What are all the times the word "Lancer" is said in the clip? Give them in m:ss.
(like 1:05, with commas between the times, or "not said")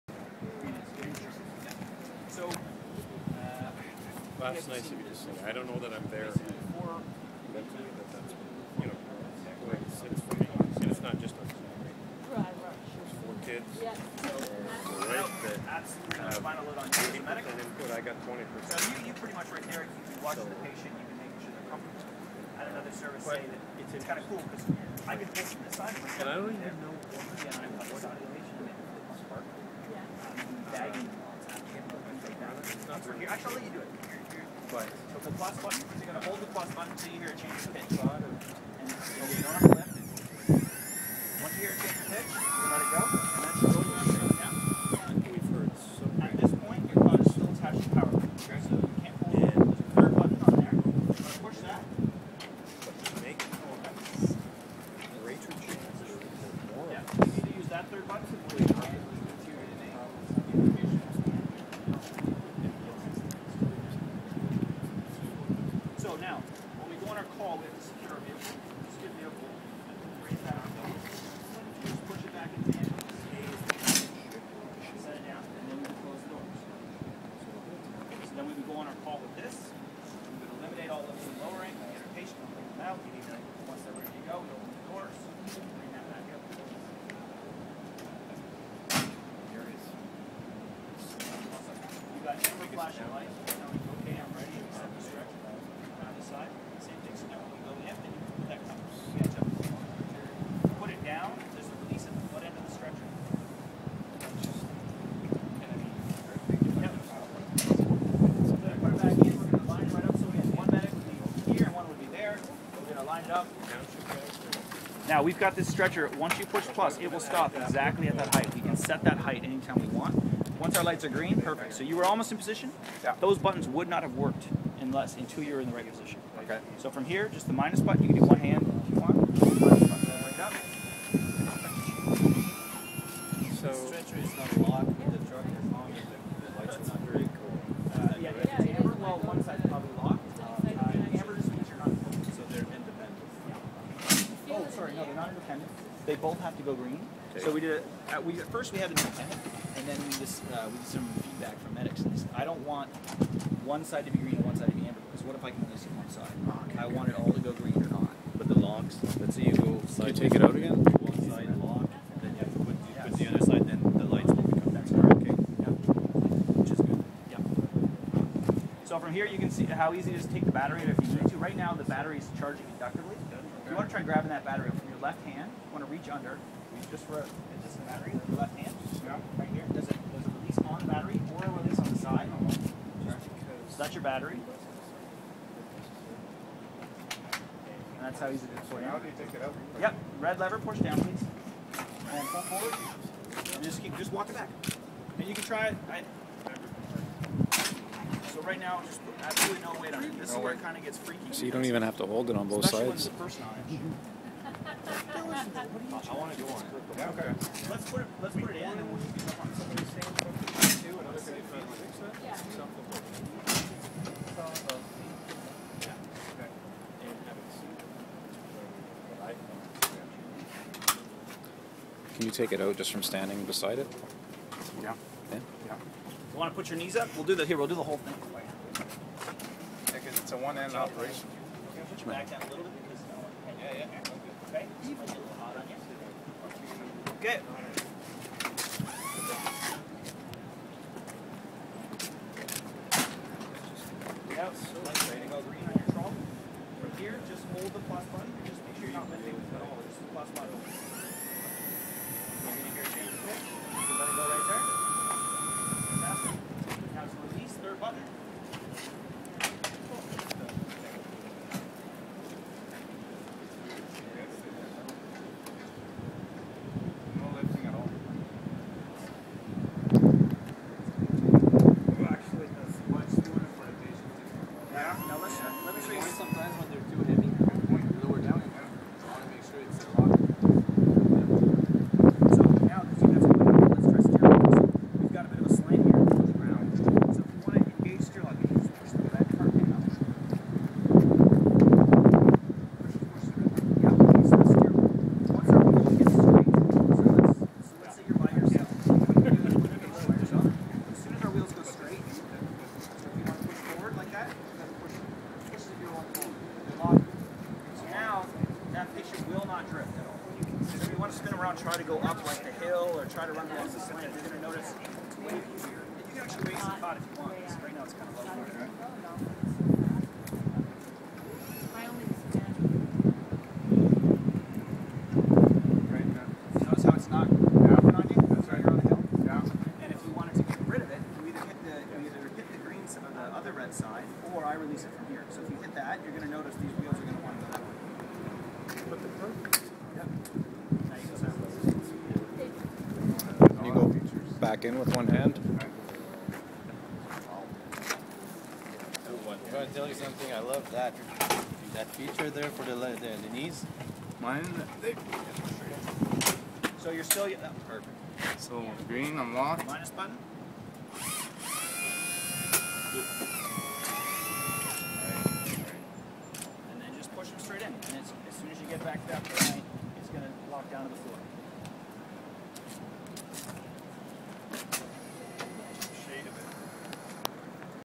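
not said.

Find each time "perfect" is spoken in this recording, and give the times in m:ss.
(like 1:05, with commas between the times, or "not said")
2:01, 5:57.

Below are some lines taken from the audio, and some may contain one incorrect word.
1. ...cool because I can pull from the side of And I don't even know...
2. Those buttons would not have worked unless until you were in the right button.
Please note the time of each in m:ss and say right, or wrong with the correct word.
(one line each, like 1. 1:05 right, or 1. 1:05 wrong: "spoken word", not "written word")
1. 0:24 right
2. 2:03 wrong: "position", not "button".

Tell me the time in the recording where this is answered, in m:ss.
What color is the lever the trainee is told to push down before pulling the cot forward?
3:10.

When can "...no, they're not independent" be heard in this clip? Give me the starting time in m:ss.
2:24.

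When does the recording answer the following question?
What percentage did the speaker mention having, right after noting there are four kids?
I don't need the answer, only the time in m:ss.
0:18.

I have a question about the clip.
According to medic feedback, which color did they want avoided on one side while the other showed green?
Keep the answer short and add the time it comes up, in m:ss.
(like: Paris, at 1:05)
amber, at 2:34.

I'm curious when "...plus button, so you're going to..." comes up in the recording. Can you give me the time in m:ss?
0:35.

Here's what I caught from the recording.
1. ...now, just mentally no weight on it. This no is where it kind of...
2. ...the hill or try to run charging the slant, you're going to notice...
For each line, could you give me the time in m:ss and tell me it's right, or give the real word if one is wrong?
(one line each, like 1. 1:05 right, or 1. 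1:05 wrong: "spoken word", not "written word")
1. 3:18 wrong: "absolutely", not "mentally"
2. 5:12 wrong: "along", not "charging".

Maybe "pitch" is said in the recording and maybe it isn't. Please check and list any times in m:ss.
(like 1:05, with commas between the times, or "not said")
0:37, 0:42.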